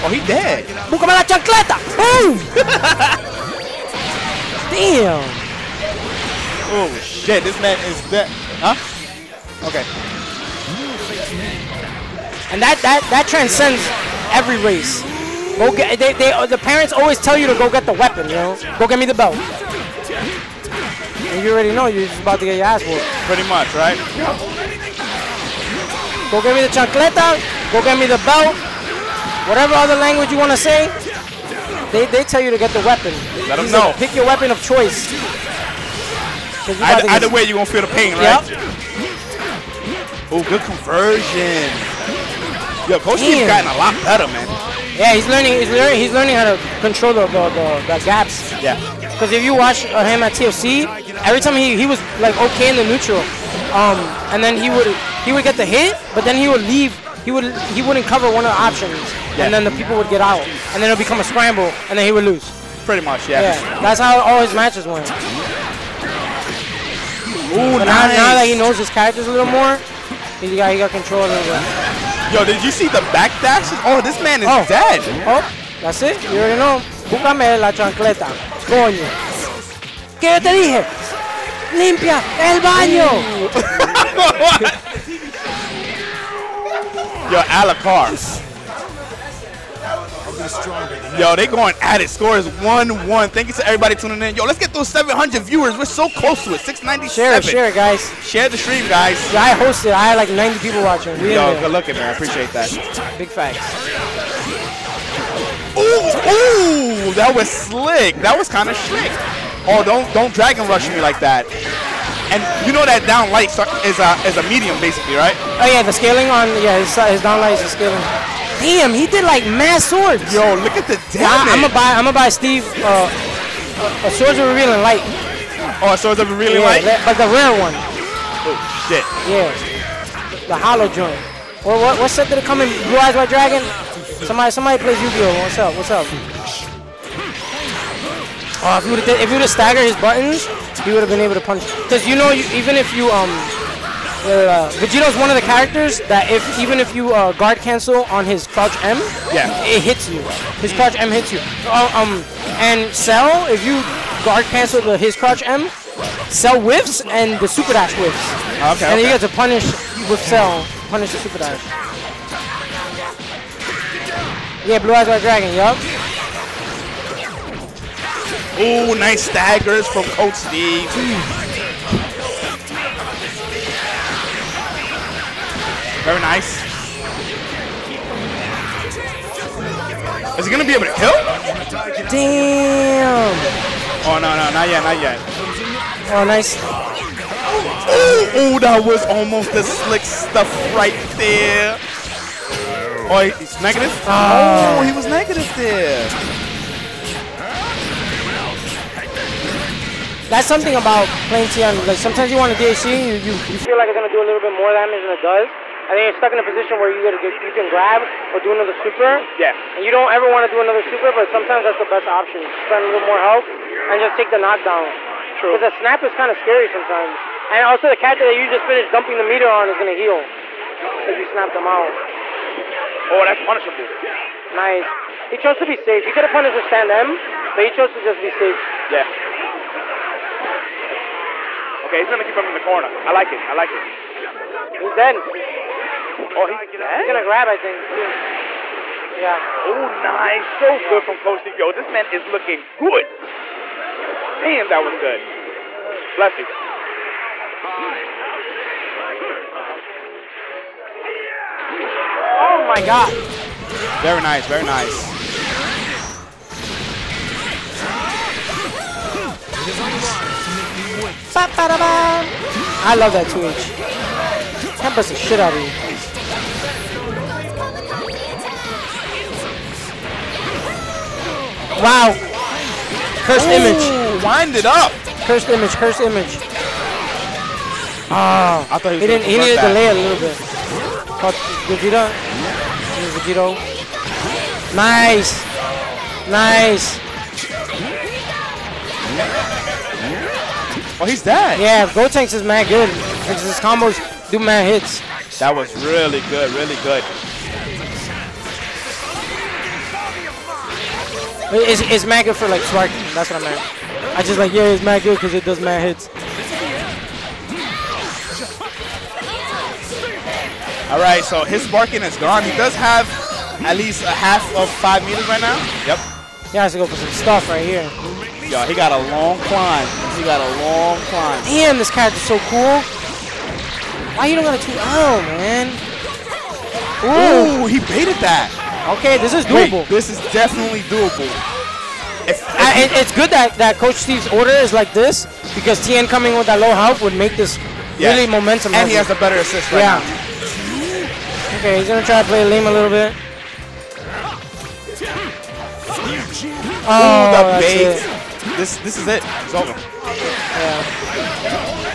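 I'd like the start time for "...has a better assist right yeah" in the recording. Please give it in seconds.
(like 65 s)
338 s.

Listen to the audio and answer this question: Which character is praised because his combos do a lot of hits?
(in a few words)
Gotenks.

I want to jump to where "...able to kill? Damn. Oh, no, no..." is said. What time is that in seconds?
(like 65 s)
180 s.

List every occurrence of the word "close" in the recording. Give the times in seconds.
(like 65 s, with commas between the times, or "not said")
96 s.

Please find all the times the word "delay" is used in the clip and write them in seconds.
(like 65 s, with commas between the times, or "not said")
279 s.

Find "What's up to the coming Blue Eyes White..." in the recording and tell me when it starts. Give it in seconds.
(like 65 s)
132 s.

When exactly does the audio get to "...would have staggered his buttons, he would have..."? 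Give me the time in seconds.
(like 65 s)
139 s.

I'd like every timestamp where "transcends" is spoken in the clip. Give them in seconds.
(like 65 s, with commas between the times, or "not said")
13 s.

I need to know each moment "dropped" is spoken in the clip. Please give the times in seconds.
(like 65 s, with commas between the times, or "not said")
not said.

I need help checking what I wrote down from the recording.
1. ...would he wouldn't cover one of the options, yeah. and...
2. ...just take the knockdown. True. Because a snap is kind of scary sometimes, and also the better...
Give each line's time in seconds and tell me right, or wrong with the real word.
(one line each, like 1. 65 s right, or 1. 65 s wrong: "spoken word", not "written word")
1. 57 s right
2. 214 s wrong: "character", not "better".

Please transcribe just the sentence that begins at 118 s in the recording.
Damn, he did like mass swords.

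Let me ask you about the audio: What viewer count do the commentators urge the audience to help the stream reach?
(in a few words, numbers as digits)
700.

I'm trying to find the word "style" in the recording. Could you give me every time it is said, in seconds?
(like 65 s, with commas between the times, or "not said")
not said.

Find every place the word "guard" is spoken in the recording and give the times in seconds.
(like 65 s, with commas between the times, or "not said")
147 s, 154 s.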